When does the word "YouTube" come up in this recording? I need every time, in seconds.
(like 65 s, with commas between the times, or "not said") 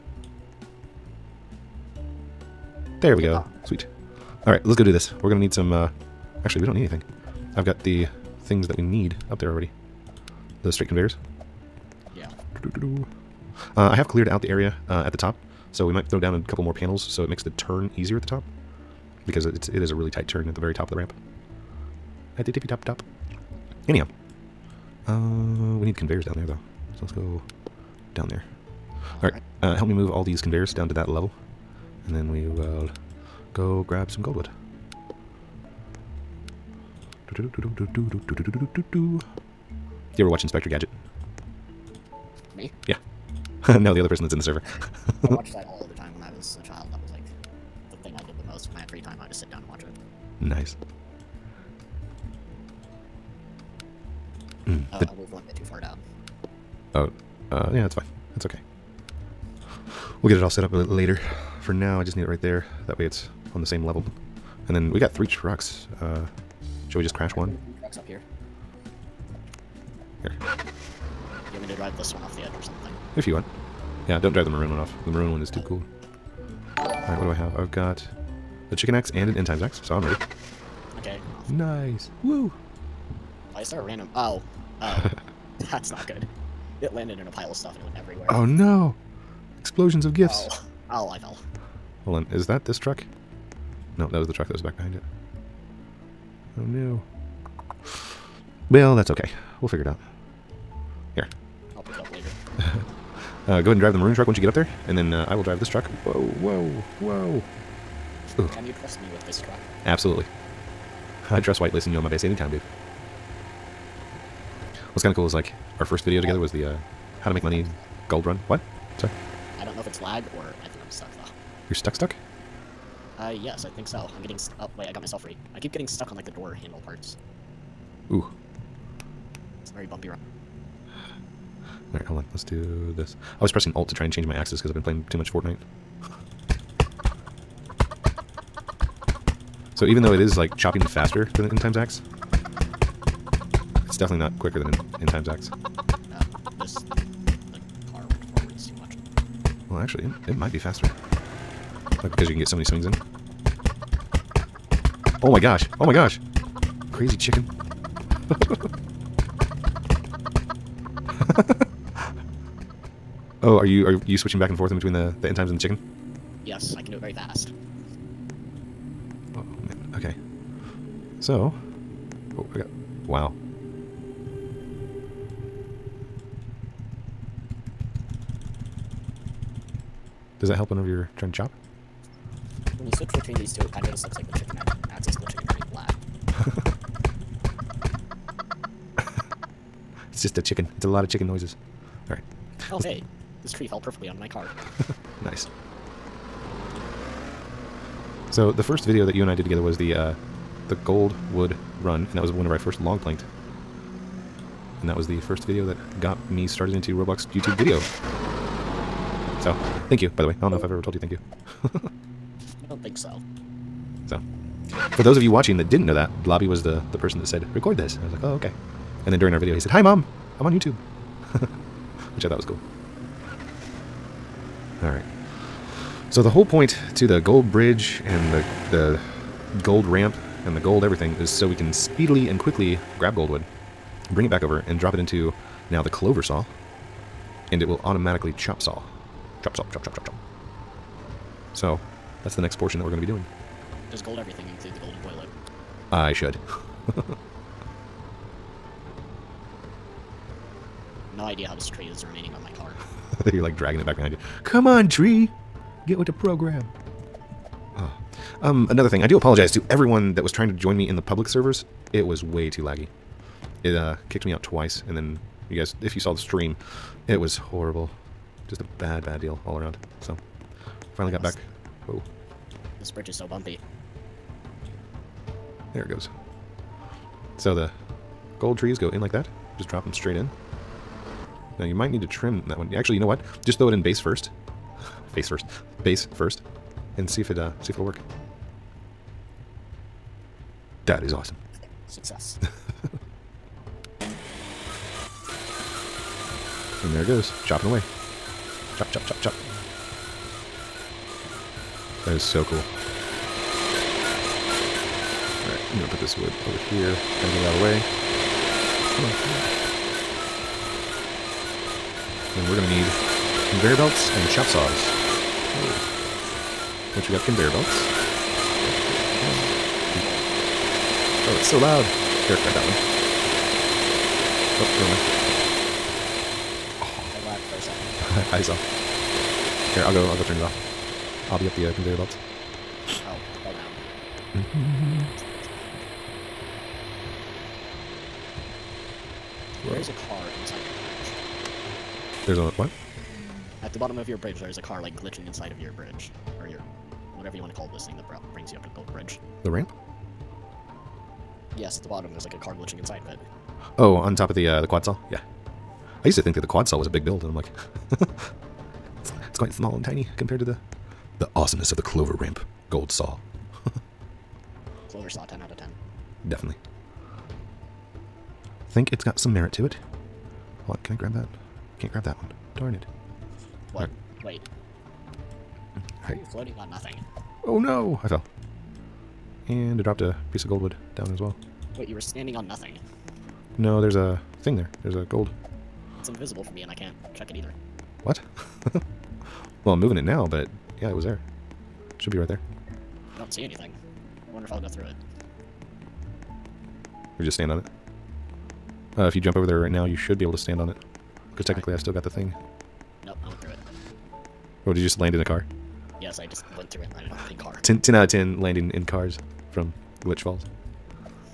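207 s, 220 s.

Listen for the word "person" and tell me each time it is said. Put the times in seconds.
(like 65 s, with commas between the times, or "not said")
44 s, 216 s.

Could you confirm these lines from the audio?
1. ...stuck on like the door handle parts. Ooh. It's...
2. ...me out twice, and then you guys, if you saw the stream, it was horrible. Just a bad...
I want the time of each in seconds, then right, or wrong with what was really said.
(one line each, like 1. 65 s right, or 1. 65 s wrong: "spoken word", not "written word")
1. 125 s right
2. 264 s right.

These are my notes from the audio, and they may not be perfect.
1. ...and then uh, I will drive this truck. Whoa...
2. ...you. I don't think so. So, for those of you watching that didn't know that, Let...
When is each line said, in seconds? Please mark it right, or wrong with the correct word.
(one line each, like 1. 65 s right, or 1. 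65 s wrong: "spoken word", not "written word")
1. 104 s right
2. 211 s wrong: "Bloby", not "Let".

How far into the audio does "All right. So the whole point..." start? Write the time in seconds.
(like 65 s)
224 s.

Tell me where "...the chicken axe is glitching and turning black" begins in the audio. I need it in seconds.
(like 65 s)
184 s.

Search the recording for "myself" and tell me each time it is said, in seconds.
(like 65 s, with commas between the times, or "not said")
125 s.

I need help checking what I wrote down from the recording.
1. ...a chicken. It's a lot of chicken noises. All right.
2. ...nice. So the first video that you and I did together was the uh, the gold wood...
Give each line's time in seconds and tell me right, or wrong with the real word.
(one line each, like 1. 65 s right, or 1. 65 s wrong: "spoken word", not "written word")
1. 190 s right
2. 195 s right.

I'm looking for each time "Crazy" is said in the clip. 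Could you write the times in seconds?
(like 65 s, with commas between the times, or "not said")
156 s.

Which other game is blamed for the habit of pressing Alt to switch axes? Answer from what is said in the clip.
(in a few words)
Fortnite.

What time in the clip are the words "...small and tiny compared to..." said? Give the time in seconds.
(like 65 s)
359 s.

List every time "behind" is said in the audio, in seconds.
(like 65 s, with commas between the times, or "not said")
94 s, 253 s.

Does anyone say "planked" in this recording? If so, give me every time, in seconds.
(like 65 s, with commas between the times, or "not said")
202 s.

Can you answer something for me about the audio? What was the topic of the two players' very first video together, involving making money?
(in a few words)
Gold run.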